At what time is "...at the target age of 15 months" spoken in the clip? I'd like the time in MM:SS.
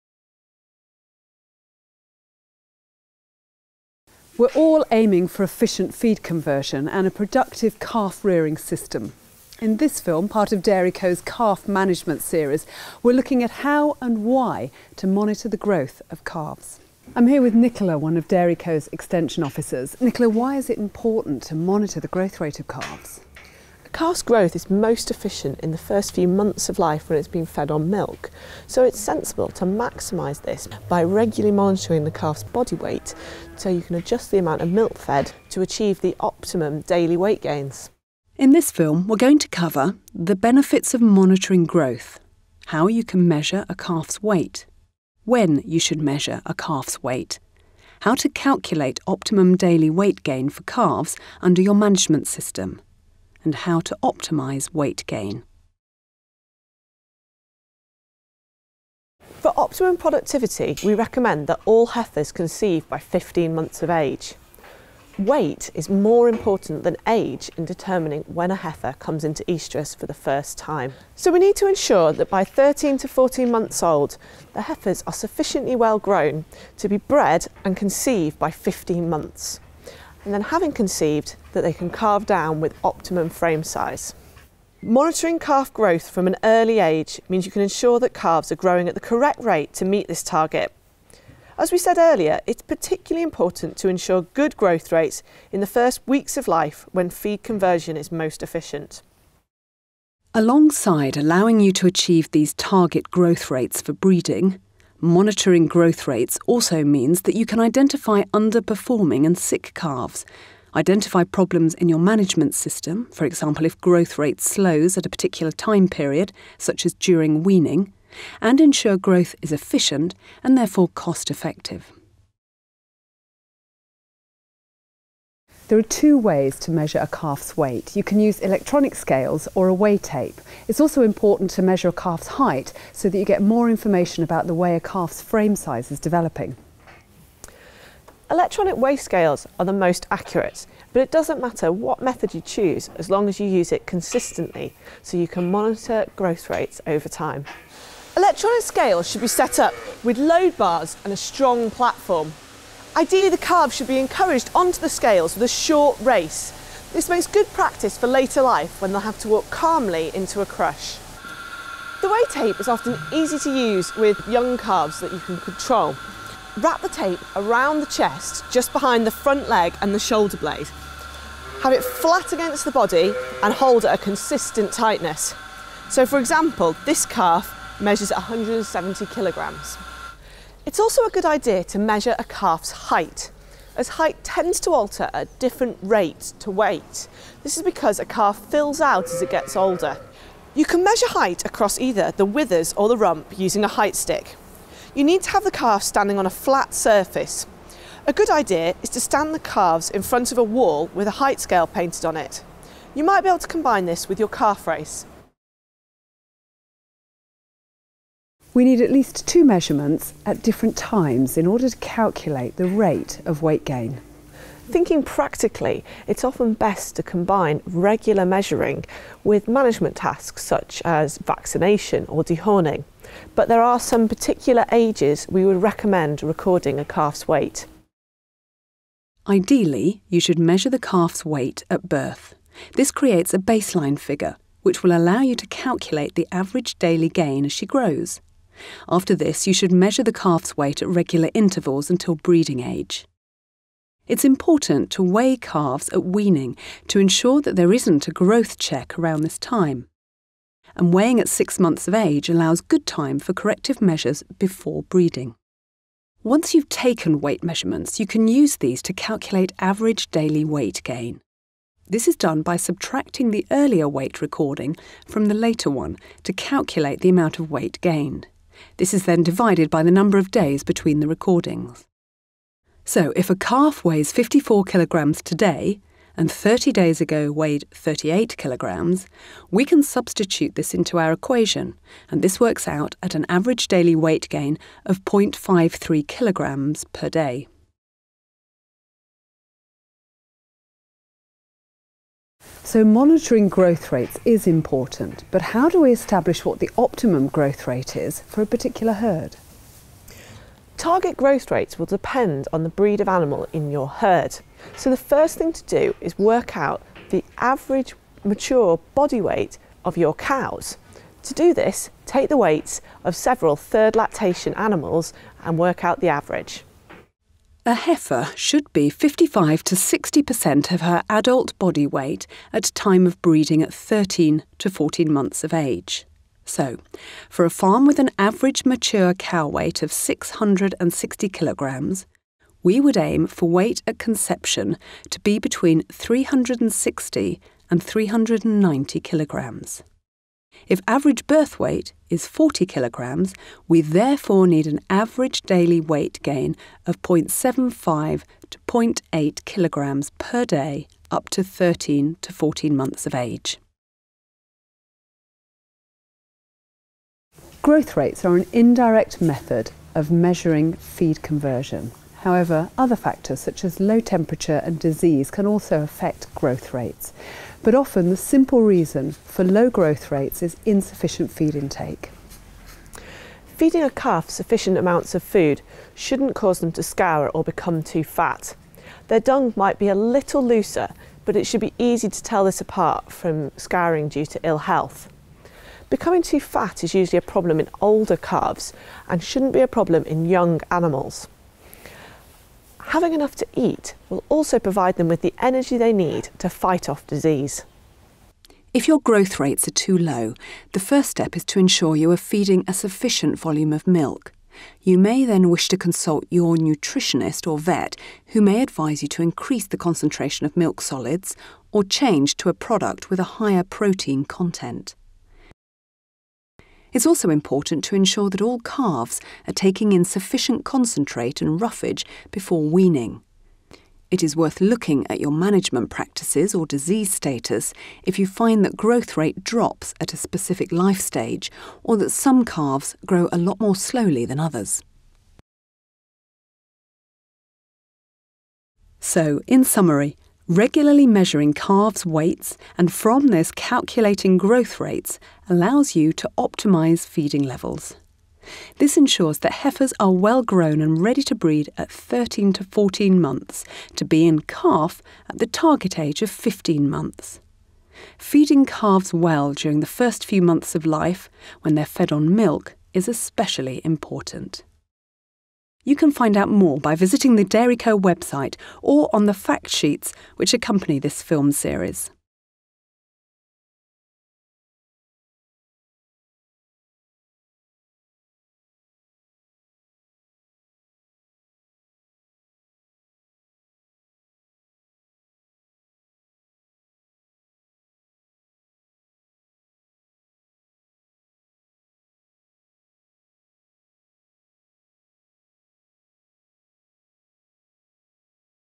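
07:35.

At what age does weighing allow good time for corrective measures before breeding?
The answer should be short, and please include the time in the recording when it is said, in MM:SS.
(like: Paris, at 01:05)
six months, at 04:11.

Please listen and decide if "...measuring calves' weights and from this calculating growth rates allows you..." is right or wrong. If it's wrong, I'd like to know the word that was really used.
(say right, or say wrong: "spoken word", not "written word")
right.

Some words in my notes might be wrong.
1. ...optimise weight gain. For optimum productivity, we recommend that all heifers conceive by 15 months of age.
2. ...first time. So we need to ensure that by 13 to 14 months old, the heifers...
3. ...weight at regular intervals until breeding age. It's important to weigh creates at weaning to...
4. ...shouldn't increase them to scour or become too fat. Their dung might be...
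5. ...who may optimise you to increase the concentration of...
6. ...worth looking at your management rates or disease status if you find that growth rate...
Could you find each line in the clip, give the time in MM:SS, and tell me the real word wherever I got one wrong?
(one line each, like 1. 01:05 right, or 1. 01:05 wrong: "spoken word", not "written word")
1. 00:54 right
2. 01:10 right
3. 04:00 wrong: "calves", not "creates"
4. 06:15 wrong: "cause", not "increase"
5. 06:48 wrong: "advise", not "optimise"
6. 07:04 wrong: "practices", not "rates".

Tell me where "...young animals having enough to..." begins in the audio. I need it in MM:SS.
06:30.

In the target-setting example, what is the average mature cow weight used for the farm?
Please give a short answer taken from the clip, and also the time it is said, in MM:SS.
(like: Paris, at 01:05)
660 kilograms, at 05:29.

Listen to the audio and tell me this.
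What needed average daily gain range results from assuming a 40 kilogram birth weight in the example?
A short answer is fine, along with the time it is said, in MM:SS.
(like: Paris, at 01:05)
0.75 to 0.8 kilograms per day, at 05:47.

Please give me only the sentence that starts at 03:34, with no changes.
Thinking practically, it's often best to combine regular measuring with management tasks such as vaccination or dehorning.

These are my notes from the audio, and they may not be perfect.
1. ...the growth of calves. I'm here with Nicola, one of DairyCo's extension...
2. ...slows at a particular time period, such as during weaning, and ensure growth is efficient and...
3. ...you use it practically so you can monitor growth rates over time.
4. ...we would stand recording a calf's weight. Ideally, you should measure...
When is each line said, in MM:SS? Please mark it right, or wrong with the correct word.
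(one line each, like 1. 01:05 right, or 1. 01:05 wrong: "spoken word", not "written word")
1. 00:15 right
2. 01:54 right
3. 02:23 wrong: "consistently", not "practically"
4. 03:45 wrong: "recommend", not "stand".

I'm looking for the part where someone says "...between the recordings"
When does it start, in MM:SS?
04:30.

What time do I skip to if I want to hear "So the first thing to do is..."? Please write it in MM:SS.
05:04.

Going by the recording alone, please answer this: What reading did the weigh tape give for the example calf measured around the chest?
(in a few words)
170 kilograms.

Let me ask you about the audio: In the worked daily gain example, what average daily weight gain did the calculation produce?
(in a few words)
0.53 kilograms per day.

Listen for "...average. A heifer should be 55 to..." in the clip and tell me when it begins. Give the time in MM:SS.
05:16.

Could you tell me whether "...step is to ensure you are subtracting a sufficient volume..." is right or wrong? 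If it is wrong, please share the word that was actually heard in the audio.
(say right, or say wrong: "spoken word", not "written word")
wrong: "feeding", not "subtracting".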